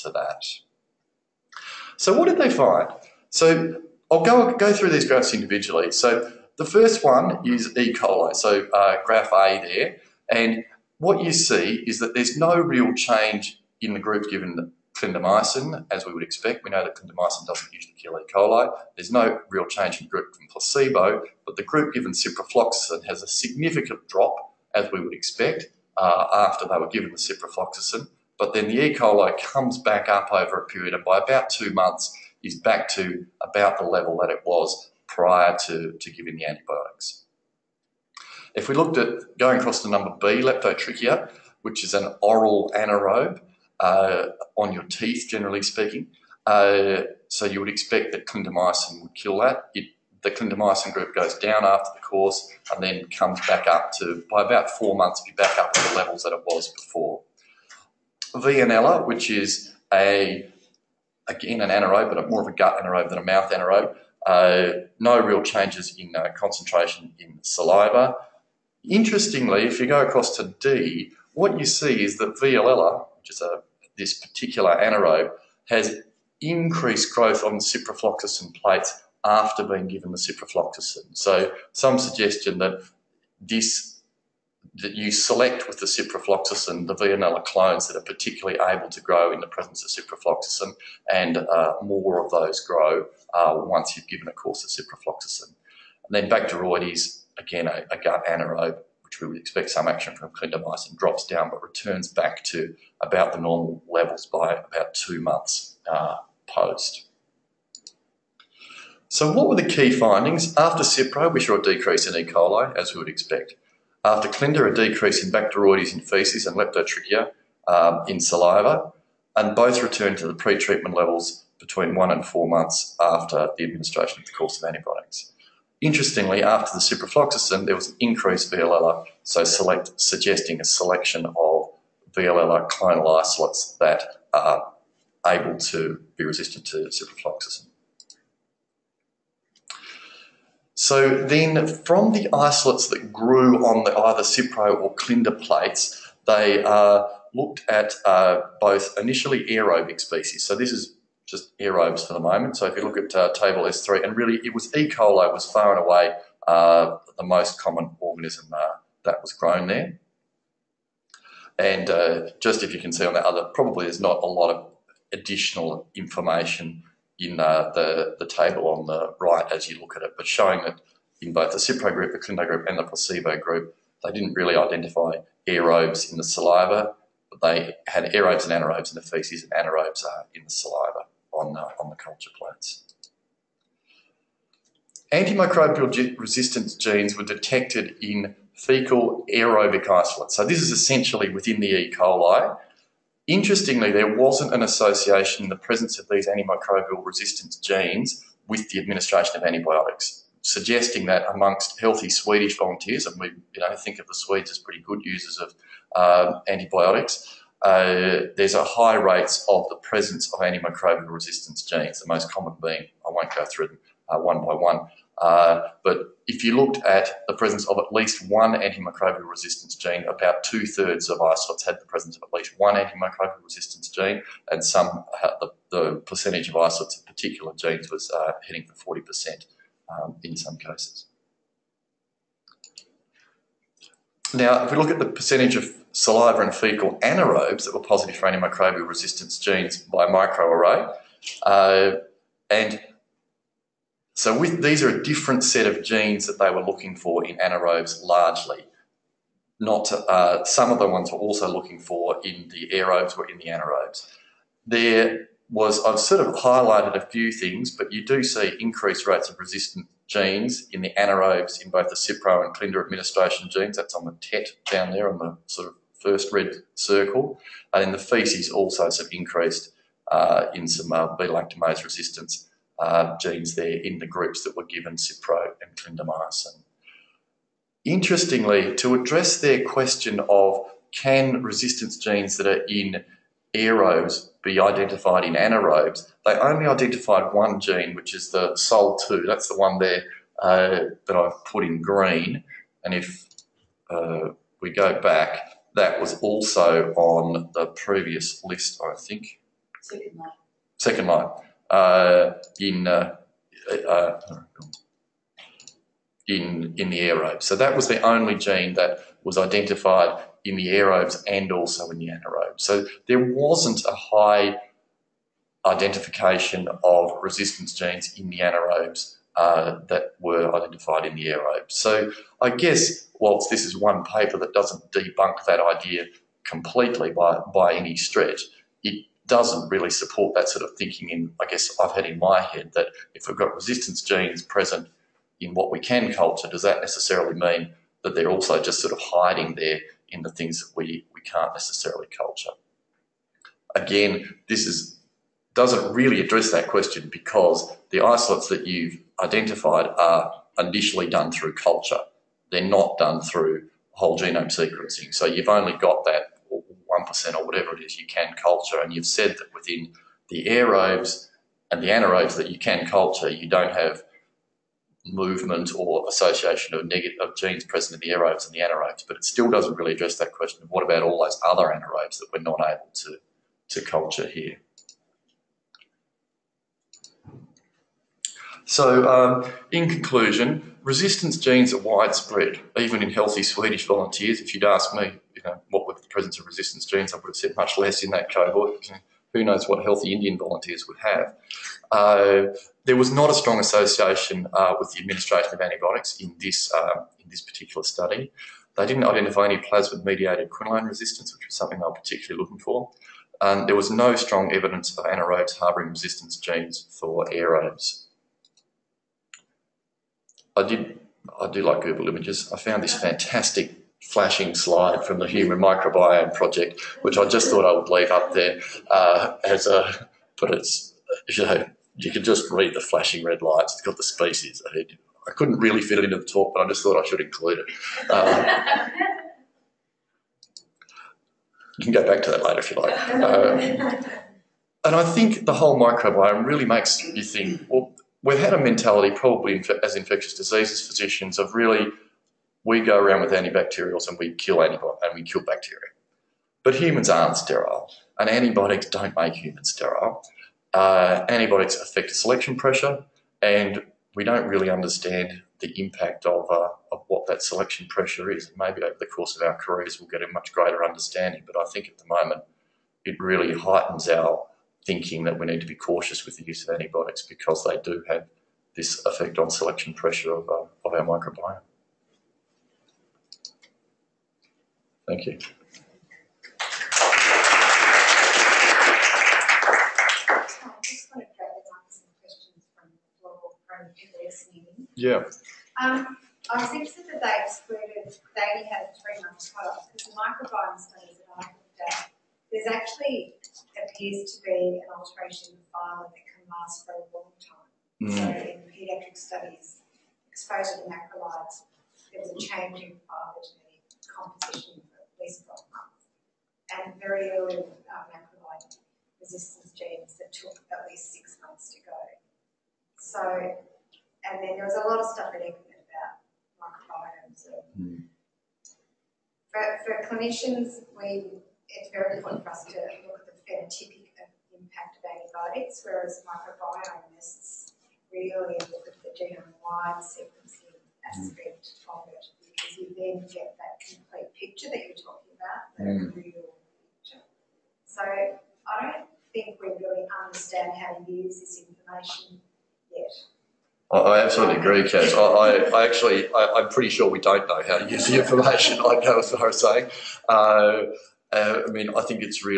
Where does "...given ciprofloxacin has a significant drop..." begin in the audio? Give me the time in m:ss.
0:21.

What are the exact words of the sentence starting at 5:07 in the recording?
So that was the only gene that was identified in the aerobes and also in the anaerobes.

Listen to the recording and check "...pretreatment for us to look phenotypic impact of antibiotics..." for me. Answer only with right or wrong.
wrong.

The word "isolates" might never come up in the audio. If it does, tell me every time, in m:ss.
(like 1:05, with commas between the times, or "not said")
2:13, 2:22, 3:09, 3:41, 3:46, 5:48.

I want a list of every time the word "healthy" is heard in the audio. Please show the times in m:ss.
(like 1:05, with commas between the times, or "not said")
3:21, 6:23, 6:29.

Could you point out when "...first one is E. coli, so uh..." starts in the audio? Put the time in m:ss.
0:06.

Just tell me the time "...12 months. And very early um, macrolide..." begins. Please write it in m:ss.
8:25.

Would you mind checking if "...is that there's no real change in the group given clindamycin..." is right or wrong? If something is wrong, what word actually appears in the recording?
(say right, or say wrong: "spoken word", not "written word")
right.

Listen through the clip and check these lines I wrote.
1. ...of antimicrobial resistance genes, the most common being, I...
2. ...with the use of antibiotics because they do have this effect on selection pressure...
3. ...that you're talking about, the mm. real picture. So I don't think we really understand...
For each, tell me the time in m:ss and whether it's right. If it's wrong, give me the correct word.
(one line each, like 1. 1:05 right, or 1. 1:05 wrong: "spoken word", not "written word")
1. 3:30 right
2. 7:46 right
3. 8:54 right.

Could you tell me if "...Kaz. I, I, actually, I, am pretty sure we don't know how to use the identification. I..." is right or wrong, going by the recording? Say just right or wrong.
wrong.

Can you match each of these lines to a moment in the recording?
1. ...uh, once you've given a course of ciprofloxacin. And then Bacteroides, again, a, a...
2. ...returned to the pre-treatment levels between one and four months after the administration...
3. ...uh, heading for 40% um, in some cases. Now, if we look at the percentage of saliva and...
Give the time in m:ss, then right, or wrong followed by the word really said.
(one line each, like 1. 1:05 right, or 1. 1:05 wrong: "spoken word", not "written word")
1. 1:33 right
2. 1:59 right
3. 3:48 right.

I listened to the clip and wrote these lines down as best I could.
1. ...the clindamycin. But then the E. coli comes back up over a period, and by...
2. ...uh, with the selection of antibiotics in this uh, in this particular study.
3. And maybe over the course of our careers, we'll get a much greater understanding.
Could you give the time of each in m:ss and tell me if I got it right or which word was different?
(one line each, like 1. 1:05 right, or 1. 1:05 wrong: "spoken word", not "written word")
1. 0:27 wrong: "ciprofloxacin", not "clindamycin"
2. 6:34 wrong: "administration", not "selection"
3. 7:38 right.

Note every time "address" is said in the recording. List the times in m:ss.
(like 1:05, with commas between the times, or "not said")
4:38, 5:46, 6:09.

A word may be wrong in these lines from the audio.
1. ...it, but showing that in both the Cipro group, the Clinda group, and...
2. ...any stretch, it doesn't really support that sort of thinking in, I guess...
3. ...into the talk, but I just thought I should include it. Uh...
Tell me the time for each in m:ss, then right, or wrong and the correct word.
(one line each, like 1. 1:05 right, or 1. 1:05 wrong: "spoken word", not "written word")
1. 2:50 right
2. 5:27 right
3. 7:06 right.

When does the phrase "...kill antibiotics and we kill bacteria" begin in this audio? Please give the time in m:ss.
7:24.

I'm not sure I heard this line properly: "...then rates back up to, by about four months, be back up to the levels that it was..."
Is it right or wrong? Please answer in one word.
wrong.